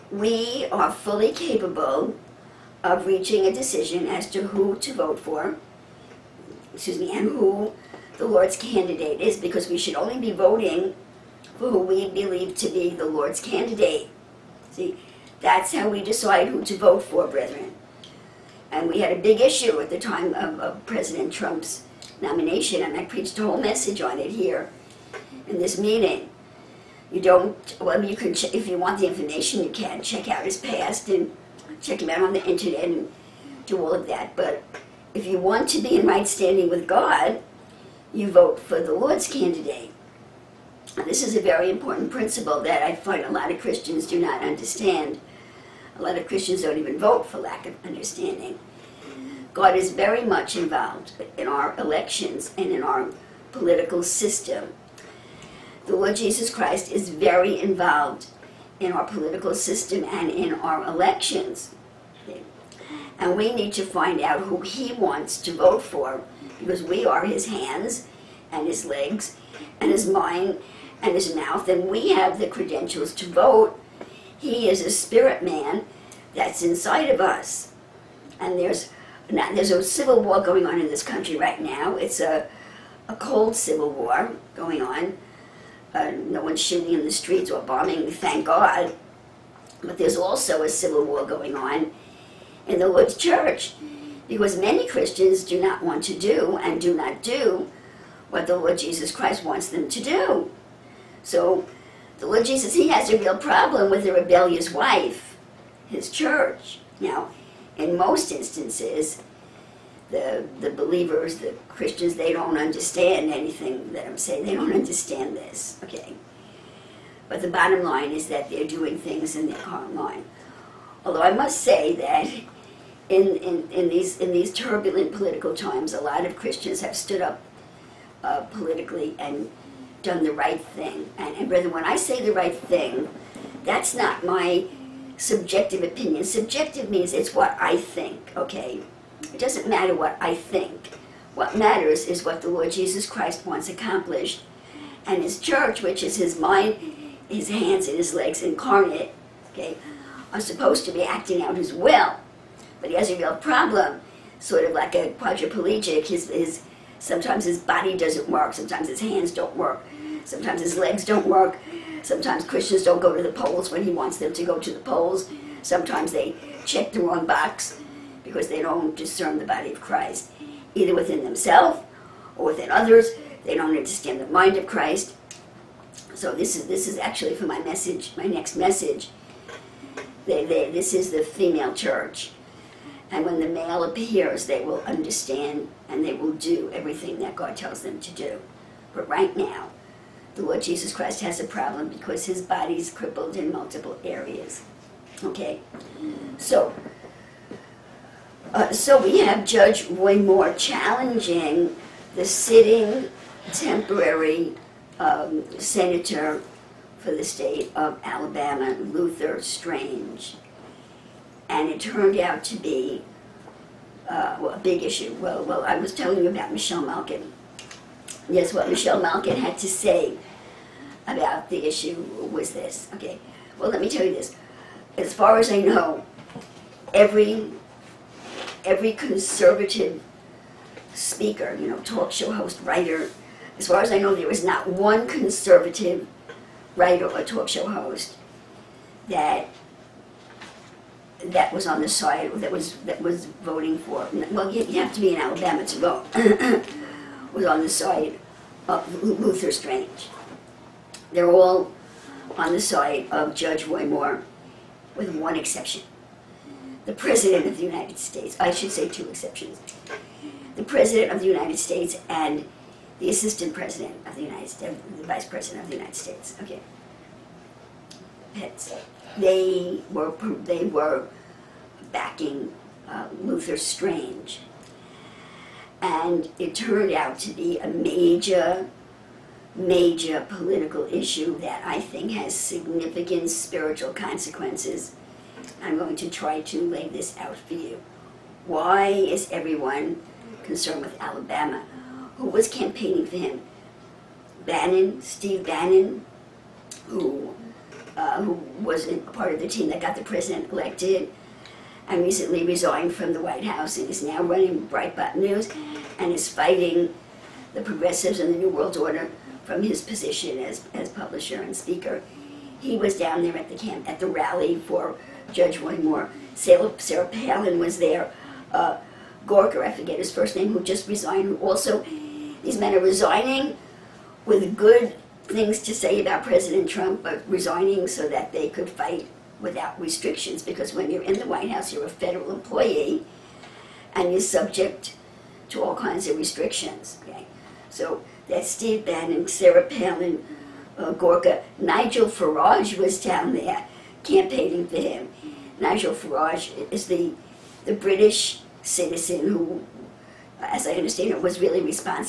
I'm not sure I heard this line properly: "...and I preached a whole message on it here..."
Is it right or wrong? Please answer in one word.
right.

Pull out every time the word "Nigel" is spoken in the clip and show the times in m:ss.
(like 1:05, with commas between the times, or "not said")
5:41, 5:45.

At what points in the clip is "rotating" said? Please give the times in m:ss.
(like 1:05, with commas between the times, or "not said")
not said.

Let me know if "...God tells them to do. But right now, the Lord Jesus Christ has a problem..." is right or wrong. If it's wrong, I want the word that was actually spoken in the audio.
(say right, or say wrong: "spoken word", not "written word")
right.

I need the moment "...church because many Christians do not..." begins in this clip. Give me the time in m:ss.
1:33.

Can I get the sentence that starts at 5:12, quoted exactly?
He was down there at the camp at the rally for Judge Roy Moore.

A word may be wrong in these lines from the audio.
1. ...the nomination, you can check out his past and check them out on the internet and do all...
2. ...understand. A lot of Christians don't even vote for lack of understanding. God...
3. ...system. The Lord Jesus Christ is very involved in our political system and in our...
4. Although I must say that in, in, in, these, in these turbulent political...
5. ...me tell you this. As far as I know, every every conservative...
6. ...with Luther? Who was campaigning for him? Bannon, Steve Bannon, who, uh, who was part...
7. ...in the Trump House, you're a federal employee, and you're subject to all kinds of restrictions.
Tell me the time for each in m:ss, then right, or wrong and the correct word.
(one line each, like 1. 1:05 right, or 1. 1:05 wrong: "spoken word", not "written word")
1. 0:28 wrong: "information", not "nomination"
2. 0:44 right
3. 0:54 right
4. 2:01 right
5. 3:43 right
6. 4:50 wrong: "Alabama", not "Luther"
7. 5:31 wrong: "White", not "Trump".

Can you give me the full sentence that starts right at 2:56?
So this is this is actually for my message, my next message.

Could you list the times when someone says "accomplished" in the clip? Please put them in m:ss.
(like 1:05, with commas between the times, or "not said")
2:23.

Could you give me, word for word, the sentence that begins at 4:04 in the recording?
Well, you, you have to be in Alabama to vote.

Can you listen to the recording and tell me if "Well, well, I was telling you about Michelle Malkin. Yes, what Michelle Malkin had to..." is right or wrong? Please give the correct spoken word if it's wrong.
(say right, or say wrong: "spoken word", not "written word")
right.